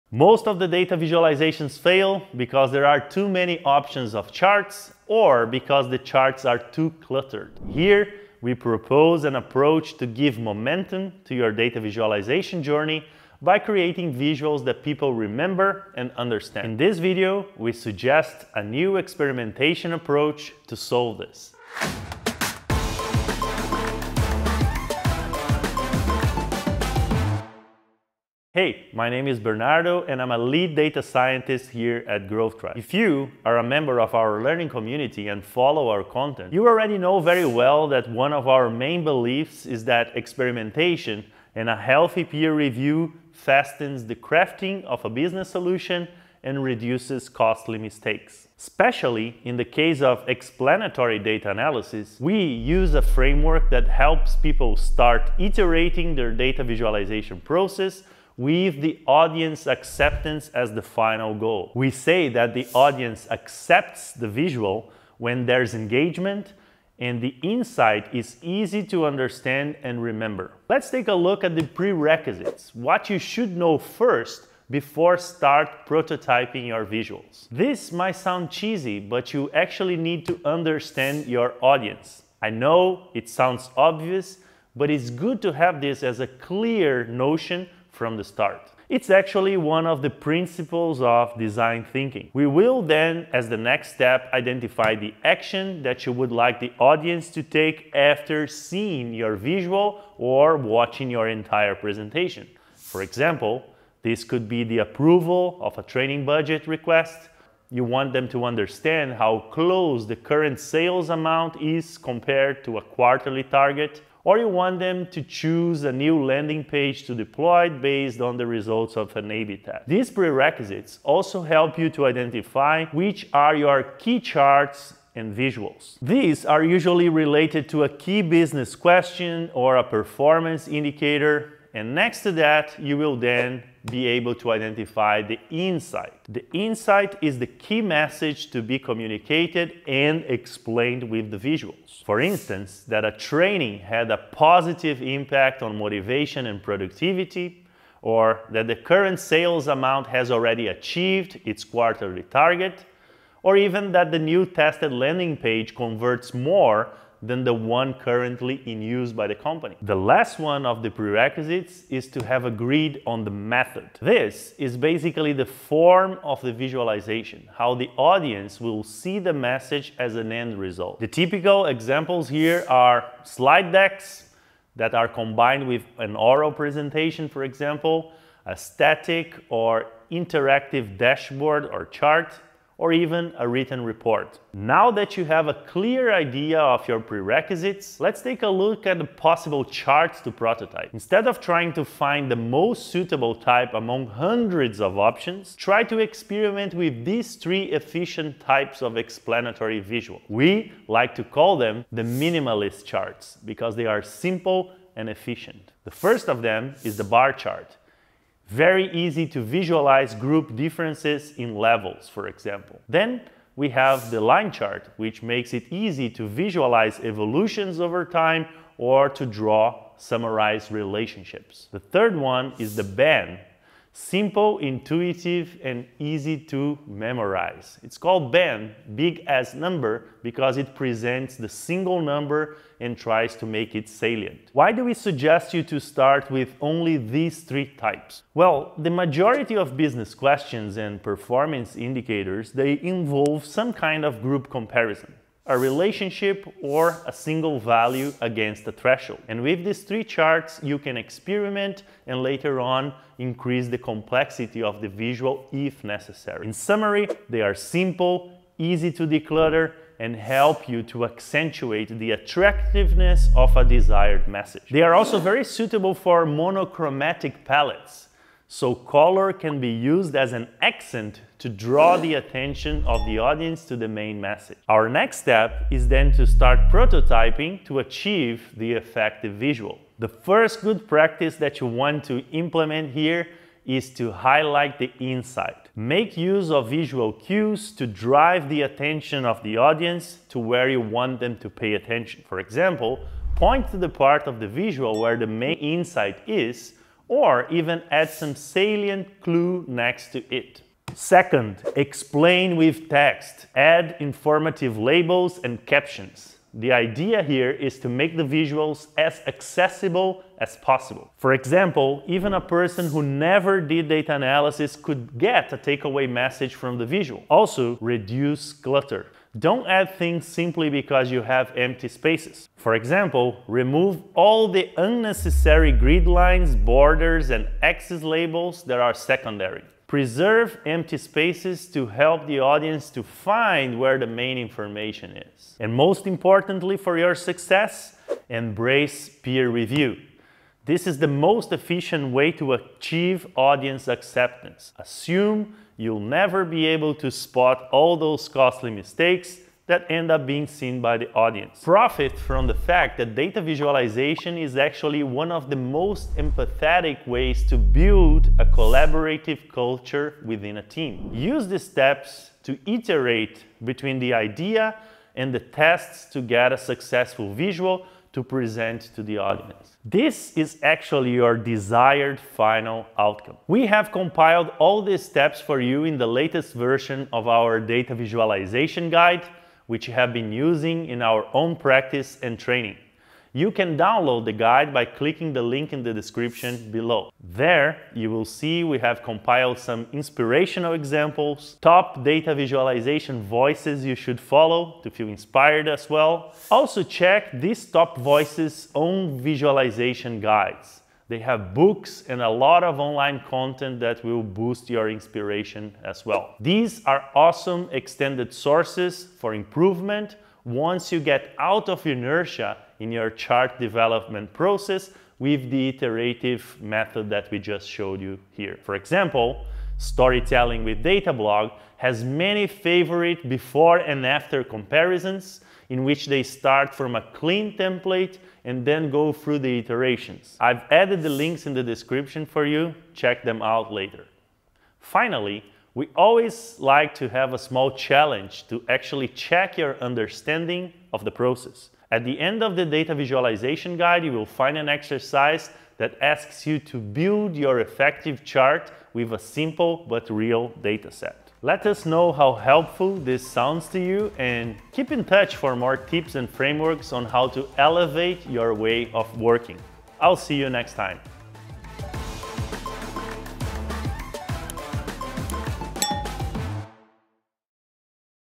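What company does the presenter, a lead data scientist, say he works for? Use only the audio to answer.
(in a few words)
Growth Tribe.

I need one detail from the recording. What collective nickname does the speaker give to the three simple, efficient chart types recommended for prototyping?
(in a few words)
minimalist charts.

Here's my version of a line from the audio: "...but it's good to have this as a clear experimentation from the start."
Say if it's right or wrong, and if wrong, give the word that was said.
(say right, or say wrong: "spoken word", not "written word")
wrong: "notion", not "experimentation".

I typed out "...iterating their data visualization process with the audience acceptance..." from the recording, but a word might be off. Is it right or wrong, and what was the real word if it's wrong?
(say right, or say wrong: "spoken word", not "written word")
right.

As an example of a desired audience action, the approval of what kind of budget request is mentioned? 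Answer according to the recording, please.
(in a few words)
training budget.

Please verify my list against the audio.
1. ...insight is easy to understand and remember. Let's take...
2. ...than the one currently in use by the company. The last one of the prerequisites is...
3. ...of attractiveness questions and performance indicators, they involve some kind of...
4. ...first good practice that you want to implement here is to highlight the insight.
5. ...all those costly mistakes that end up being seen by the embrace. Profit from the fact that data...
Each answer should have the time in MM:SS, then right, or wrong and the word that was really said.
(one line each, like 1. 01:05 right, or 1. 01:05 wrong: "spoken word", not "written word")
1. 01:07 right
2. 02:37 right
3. 03:59 wrong: "business", not "attractiveness"
4. 04:40 right
5. 05:47 wrong: "audience", not "embrace".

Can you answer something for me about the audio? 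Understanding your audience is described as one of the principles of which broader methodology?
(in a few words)
design thinking.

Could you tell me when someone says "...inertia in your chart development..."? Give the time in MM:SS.
06:51.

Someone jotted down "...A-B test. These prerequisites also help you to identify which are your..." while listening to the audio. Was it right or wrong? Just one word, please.
right.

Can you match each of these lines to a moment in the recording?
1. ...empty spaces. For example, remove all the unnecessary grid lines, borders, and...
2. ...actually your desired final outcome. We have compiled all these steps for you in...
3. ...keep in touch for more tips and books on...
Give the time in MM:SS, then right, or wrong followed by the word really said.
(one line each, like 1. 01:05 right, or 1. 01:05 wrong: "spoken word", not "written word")
1. 05:21 right
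2. 06:10 right
3. 07:34 wrong: "frameworks", not "books".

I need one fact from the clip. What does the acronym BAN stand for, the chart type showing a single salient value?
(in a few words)
big as number.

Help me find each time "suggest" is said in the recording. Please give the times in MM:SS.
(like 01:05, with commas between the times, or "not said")
00:17, 03:54.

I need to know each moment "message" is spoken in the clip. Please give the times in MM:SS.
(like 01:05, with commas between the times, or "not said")
02:17, 02:49, 04:24, 04:34, 05:16.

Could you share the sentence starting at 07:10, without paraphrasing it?
I've added the links in the description for you, check them out later.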